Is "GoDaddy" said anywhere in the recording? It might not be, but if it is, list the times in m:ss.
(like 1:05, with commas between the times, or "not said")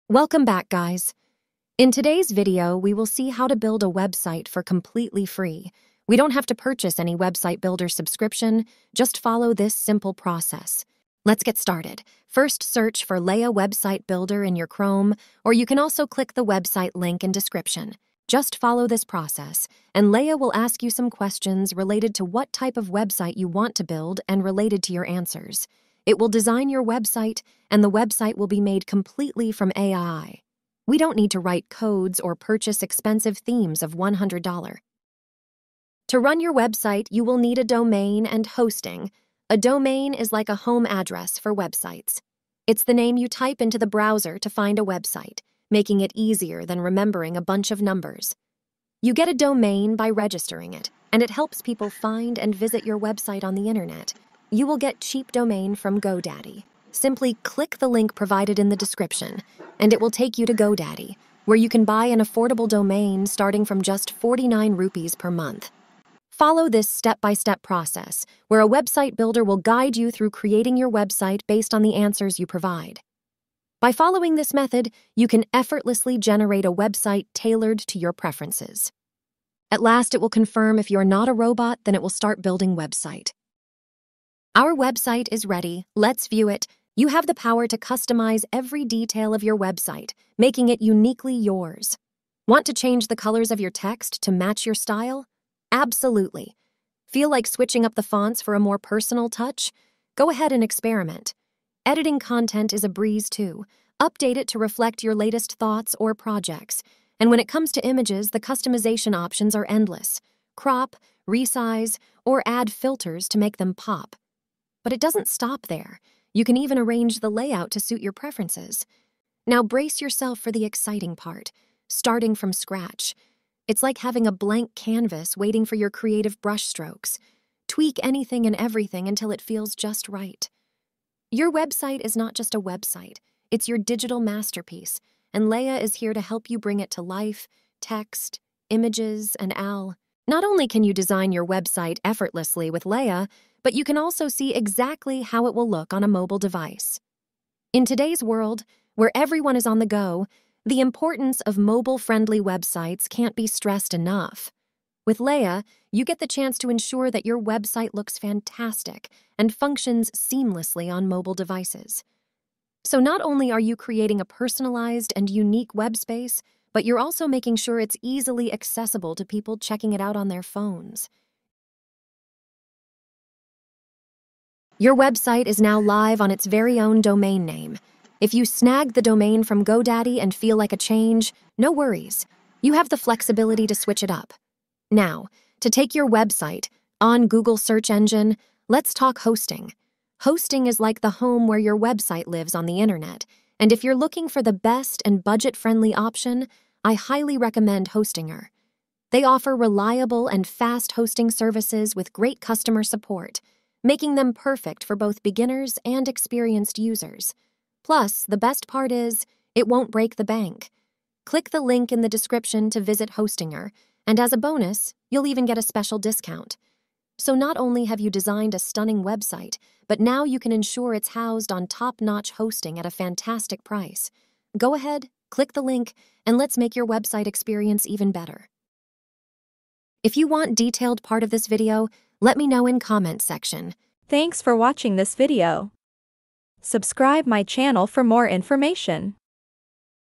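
0:56, 1:00, 2:59.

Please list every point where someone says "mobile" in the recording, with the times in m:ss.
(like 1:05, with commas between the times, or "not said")
2:26, 2:31, 2:41.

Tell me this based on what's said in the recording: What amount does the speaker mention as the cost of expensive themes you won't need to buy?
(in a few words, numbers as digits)
$100.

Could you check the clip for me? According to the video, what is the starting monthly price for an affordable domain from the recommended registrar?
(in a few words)
49 rupees per month.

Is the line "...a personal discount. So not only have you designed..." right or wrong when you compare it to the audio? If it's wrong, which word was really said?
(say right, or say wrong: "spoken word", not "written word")
wrong: "special", not "personal".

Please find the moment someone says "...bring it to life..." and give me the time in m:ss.
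2:16.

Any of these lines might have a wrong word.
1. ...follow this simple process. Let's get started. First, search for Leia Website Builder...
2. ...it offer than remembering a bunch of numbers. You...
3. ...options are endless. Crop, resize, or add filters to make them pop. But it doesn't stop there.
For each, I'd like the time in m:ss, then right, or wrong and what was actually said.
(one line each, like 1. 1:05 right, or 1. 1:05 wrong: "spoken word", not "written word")
1. 0:09 right
2. 0:46 wrong: "easier", not "offer"
3. 1:49 right.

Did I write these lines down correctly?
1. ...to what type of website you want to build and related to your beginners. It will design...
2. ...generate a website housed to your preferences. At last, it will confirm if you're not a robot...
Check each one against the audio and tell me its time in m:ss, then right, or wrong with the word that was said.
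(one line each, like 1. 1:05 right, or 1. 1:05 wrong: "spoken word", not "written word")
1. 0:22 wrong: "answers", not "beginners"
2. 1:16 wrong: "tailored", not "housed".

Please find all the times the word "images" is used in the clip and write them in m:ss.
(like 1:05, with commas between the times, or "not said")
1:47, 2:18.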